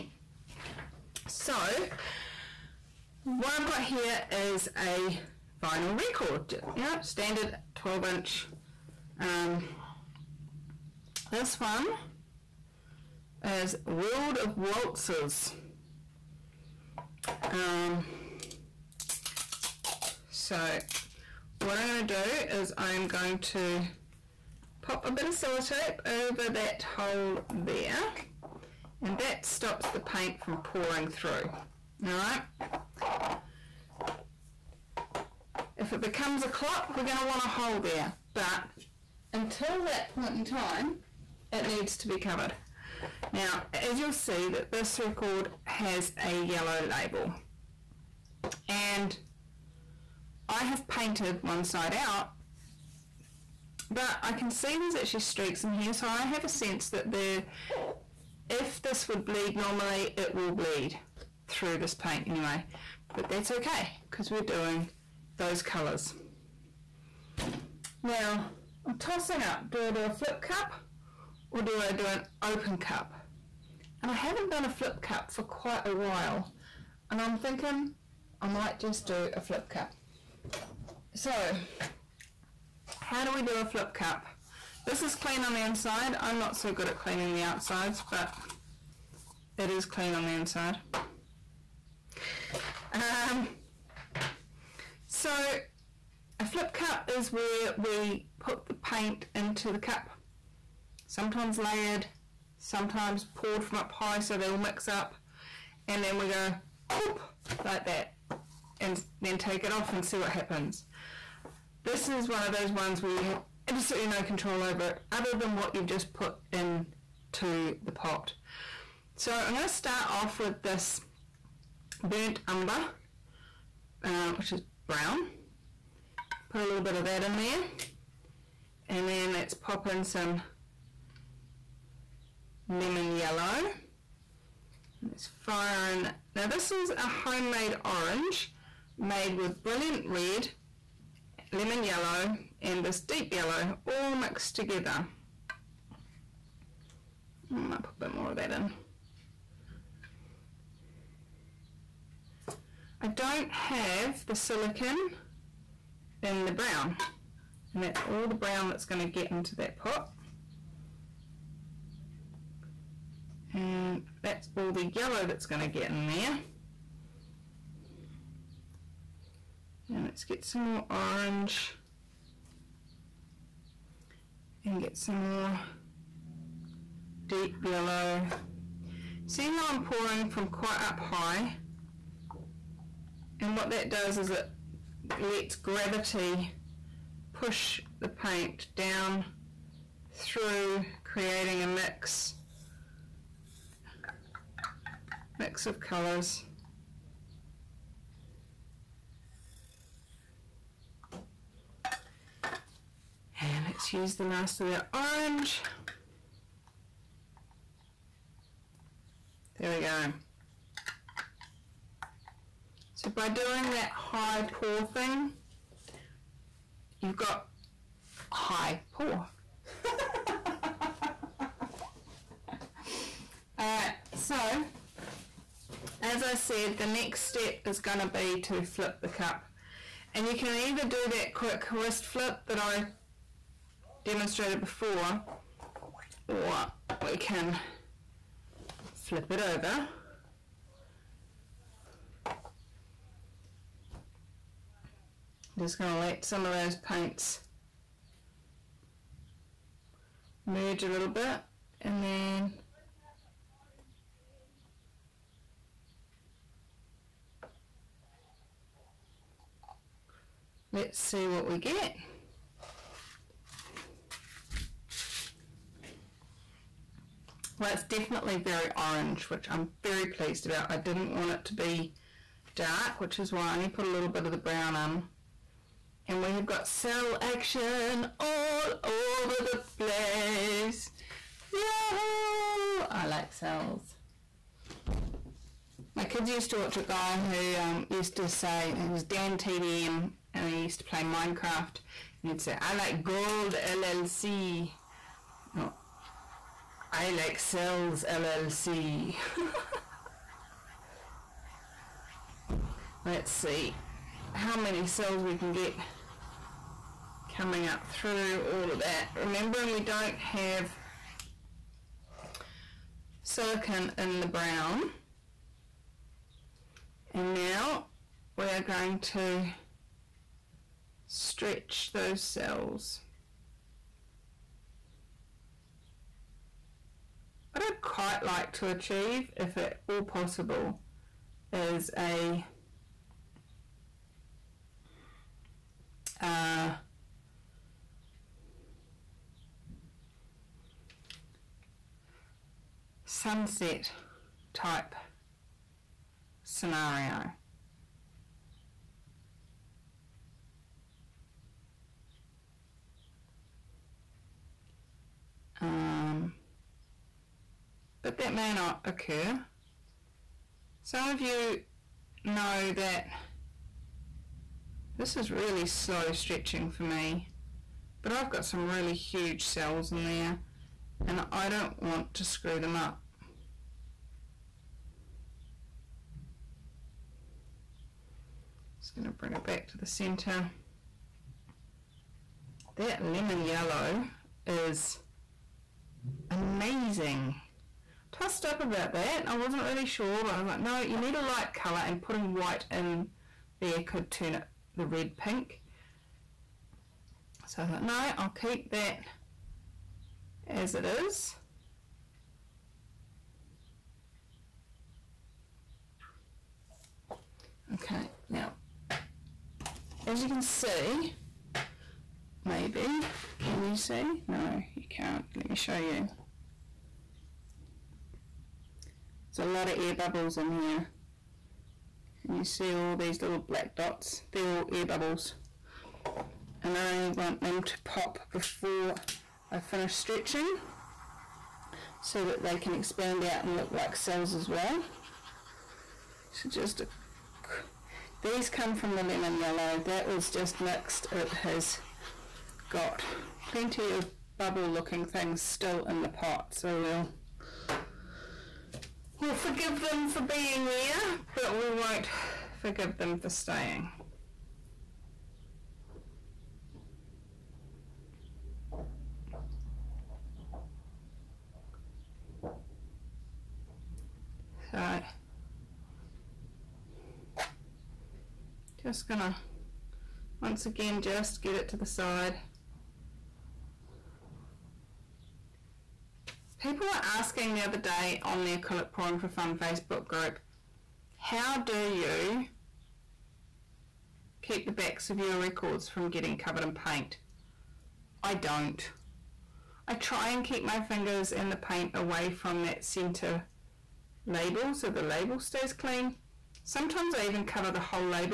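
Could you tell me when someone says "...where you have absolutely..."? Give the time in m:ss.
1:53.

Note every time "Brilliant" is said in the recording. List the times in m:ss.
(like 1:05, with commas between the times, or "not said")
2:19.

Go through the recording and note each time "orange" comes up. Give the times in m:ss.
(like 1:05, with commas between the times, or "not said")
2:17, 2:50, 3:24, 4:28.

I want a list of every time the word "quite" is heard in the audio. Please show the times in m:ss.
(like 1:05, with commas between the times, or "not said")
1:15, 3:00, 5:27.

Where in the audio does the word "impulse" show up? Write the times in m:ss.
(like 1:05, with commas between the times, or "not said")
not said.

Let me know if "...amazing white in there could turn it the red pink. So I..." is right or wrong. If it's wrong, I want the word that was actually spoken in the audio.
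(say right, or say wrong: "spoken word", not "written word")
wrong: "putting", not "amazing".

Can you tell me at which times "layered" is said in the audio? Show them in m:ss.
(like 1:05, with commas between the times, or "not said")
1:41.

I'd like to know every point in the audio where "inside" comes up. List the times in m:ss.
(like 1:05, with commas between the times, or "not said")
1:25, 1:30.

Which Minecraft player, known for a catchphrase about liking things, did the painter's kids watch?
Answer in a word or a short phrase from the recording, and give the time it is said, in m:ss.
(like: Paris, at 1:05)
Dan TDM, at 4:49.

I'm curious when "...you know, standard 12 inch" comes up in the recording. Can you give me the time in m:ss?
0:06.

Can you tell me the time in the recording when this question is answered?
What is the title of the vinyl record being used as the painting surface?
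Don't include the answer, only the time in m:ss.
0:13.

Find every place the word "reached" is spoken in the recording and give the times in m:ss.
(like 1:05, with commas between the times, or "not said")
not said.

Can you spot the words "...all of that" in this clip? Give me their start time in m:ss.
5:08.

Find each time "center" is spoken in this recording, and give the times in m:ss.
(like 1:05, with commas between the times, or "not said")
6:19, 8:12.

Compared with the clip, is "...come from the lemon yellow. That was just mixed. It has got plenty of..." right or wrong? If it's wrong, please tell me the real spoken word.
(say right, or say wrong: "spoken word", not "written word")
right.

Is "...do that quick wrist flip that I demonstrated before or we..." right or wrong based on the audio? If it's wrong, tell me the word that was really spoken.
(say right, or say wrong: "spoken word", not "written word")
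right.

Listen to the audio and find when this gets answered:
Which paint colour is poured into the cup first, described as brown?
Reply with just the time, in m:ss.
2:02.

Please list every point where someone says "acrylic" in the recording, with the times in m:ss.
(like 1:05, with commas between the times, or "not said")
7:58.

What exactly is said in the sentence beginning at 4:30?
I didn't want it to be dark, which is why I only put a little bit of the brown on.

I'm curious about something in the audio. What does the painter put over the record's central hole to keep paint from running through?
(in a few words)
Sellotape.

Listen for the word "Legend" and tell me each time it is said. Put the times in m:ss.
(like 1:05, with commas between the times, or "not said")
not said.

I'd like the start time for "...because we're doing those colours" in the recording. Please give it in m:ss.
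1:04.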